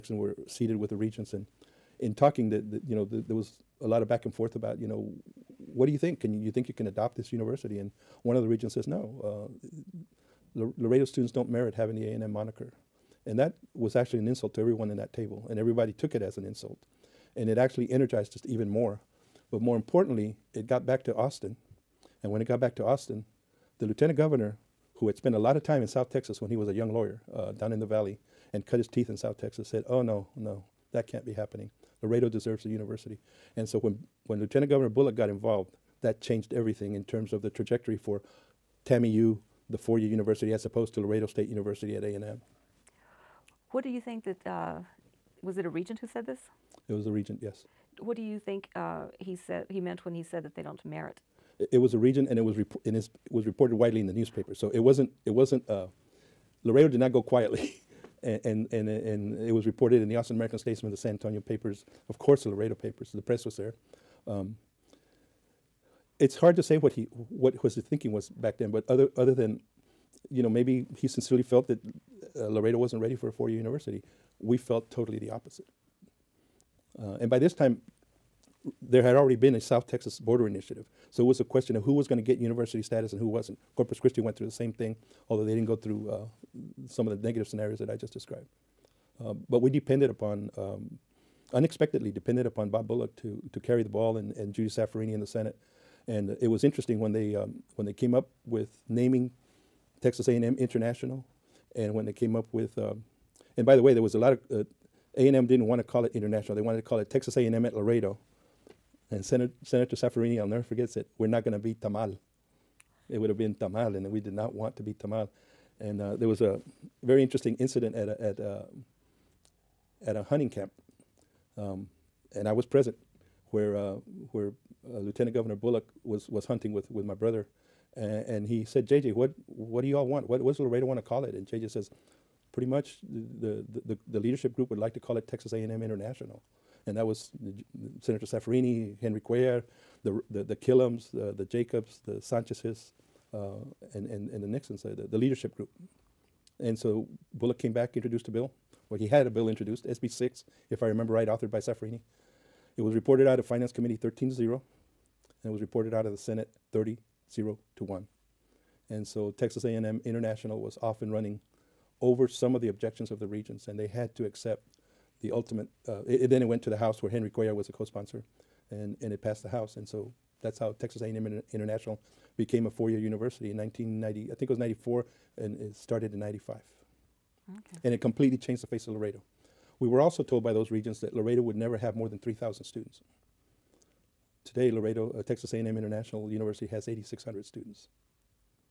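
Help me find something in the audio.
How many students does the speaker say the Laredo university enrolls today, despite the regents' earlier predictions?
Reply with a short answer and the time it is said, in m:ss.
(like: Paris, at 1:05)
8,600, at 3:06.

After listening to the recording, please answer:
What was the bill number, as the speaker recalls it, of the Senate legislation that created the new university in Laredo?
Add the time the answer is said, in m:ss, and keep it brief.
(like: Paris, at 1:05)
SB 6, at 2:29.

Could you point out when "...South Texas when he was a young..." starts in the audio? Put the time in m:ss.
0:25.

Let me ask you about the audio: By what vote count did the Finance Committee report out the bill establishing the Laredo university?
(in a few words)
13-0.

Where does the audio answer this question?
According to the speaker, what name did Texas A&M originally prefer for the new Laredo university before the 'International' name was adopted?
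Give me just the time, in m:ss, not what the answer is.
1:47.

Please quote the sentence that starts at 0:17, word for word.
And it actually energized us even more.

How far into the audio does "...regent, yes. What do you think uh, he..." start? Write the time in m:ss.
0:47.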